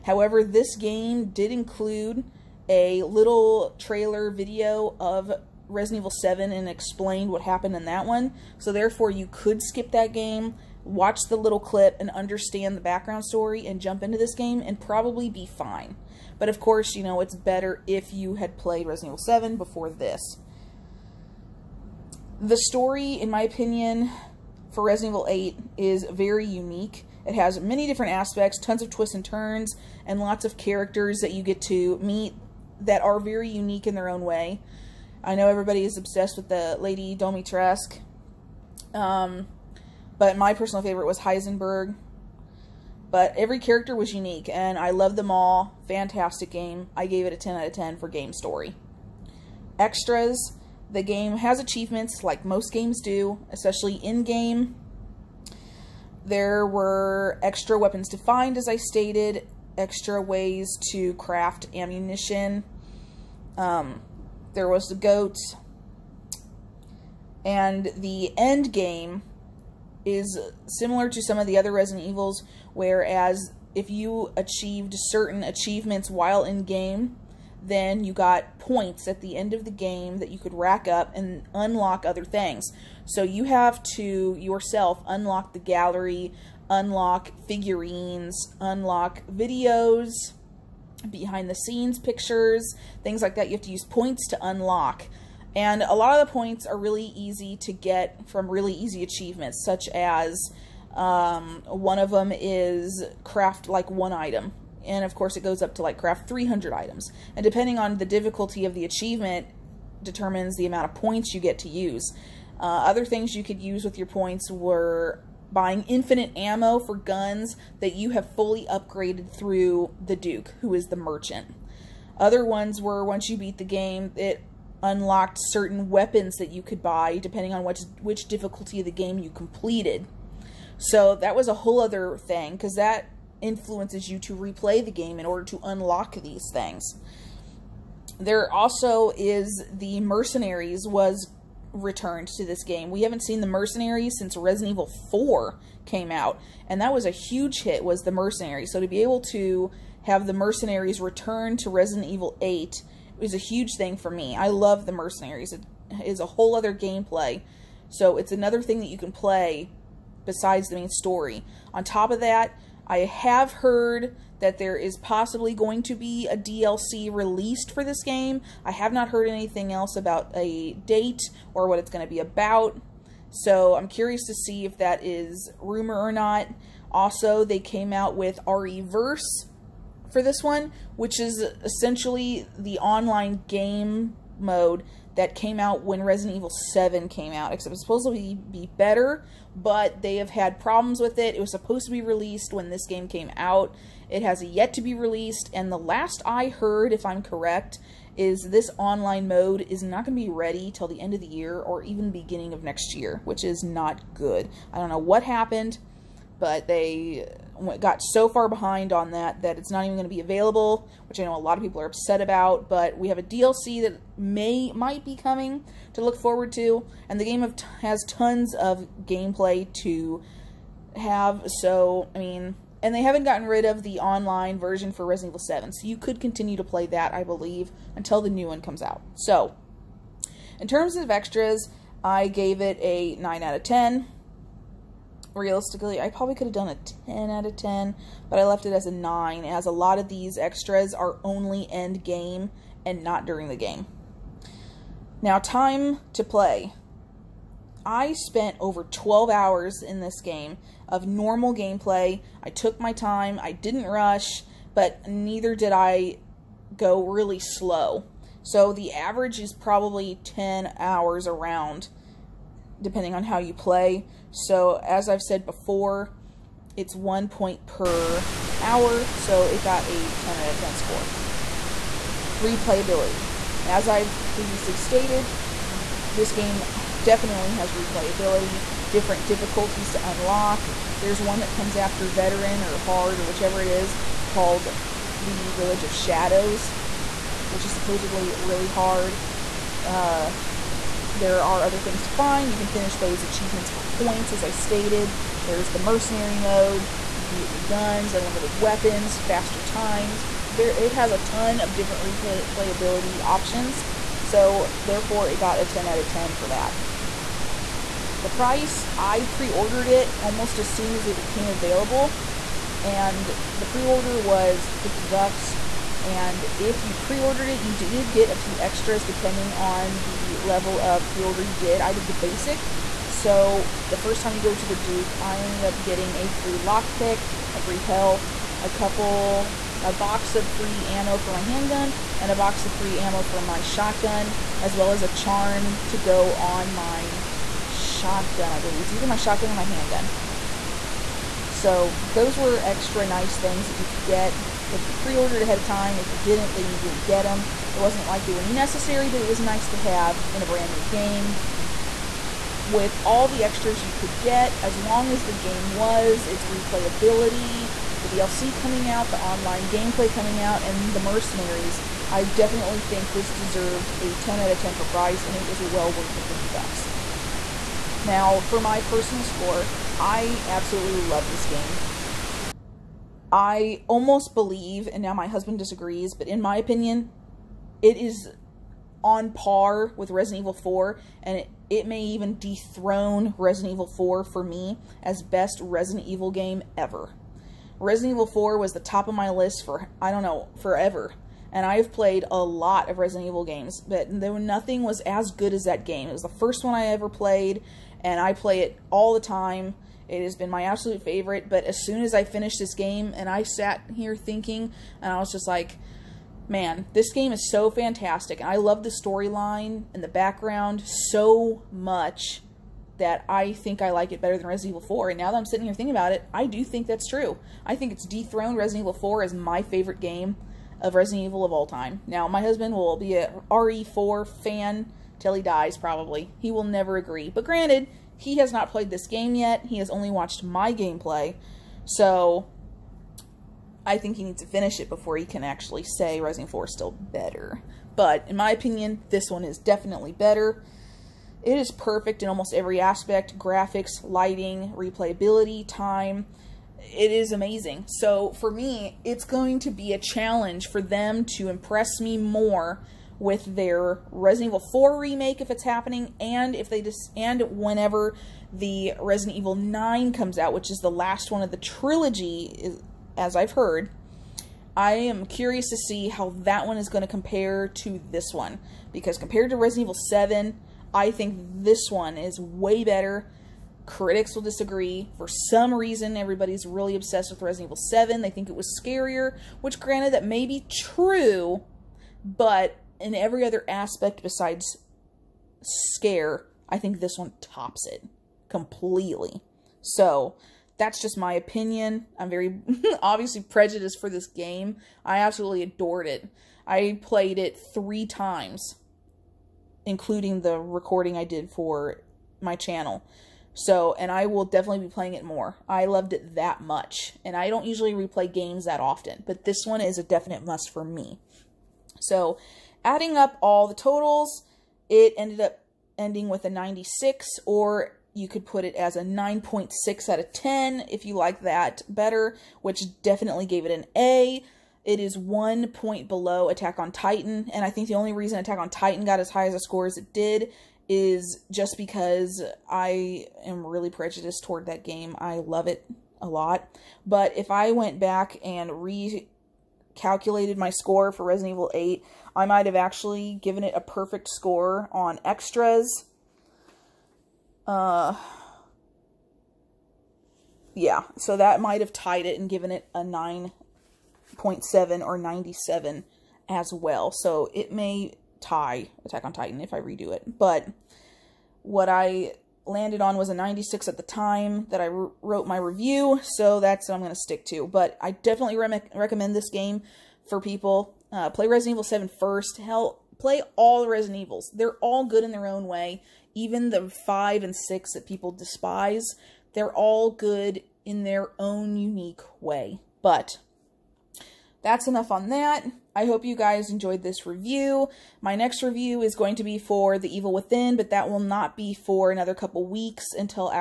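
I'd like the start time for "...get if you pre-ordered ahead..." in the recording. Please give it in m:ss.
5:44.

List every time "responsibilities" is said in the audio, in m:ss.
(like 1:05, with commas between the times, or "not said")
not said.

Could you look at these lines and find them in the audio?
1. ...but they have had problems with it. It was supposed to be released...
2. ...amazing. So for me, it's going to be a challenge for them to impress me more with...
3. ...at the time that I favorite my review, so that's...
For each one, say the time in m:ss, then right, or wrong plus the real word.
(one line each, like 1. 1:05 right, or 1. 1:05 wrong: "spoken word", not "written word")
1. 3:09 right
2. 7:27 right
3. 9:23 wrong: "wrote", not "favorite".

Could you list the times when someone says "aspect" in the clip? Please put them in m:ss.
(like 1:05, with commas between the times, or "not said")
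0:28, 7:22, 8:03.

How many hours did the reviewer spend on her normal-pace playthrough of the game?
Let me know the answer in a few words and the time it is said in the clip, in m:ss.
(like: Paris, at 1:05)
Over 12 hours, at 4:08.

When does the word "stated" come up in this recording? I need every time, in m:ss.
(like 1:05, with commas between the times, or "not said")
0:58, 4:34, 4:54.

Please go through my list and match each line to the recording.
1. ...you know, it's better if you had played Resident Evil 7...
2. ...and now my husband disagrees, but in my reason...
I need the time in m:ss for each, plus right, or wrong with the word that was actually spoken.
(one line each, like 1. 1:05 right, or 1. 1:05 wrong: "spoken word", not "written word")
1. 0:16 right
2. 6:14 wrong: "opinion", not "reason".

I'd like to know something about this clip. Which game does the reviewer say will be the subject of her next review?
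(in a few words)
The Evil Within.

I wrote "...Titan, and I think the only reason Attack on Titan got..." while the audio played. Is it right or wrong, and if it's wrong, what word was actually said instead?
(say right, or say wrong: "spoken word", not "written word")
right.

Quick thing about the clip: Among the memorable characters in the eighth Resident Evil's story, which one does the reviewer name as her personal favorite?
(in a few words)
Heisenberg.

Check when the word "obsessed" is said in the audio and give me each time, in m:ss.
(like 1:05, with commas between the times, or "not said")
0:35, 7:56.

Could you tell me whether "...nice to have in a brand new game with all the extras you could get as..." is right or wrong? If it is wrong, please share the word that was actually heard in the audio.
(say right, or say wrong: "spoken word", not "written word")
right.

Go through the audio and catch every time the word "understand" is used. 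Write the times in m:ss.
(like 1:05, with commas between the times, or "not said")
0:12.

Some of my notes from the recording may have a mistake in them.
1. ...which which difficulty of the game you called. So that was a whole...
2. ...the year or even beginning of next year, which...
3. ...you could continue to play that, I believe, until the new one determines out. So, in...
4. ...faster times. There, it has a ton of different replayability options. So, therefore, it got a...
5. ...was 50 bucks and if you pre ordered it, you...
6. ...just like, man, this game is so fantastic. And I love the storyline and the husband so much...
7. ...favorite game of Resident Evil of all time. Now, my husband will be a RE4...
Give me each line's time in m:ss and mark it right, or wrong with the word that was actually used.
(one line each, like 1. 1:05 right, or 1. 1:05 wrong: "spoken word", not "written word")
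1. 2:07 wrong: "completed", not "called"
2. 3:21 right
3. 3:45 wrong: "comes", not "determines"
4. 4:59 right
5. 5:14 right
6. 6:45 wrong: "background", not "husband"
7. 6:59 right.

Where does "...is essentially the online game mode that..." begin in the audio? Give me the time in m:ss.
3:01.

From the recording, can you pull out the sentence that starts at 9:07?
Uh, yeah, so that might have tied it and given it a 9.7 or 97 as well.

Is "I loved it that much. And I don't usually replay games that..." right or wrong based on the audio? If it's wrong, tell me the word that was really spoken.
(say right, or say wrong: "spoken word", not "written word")
right.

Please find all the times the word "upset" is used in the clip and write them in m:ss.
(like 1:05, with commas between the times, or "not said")
3:31.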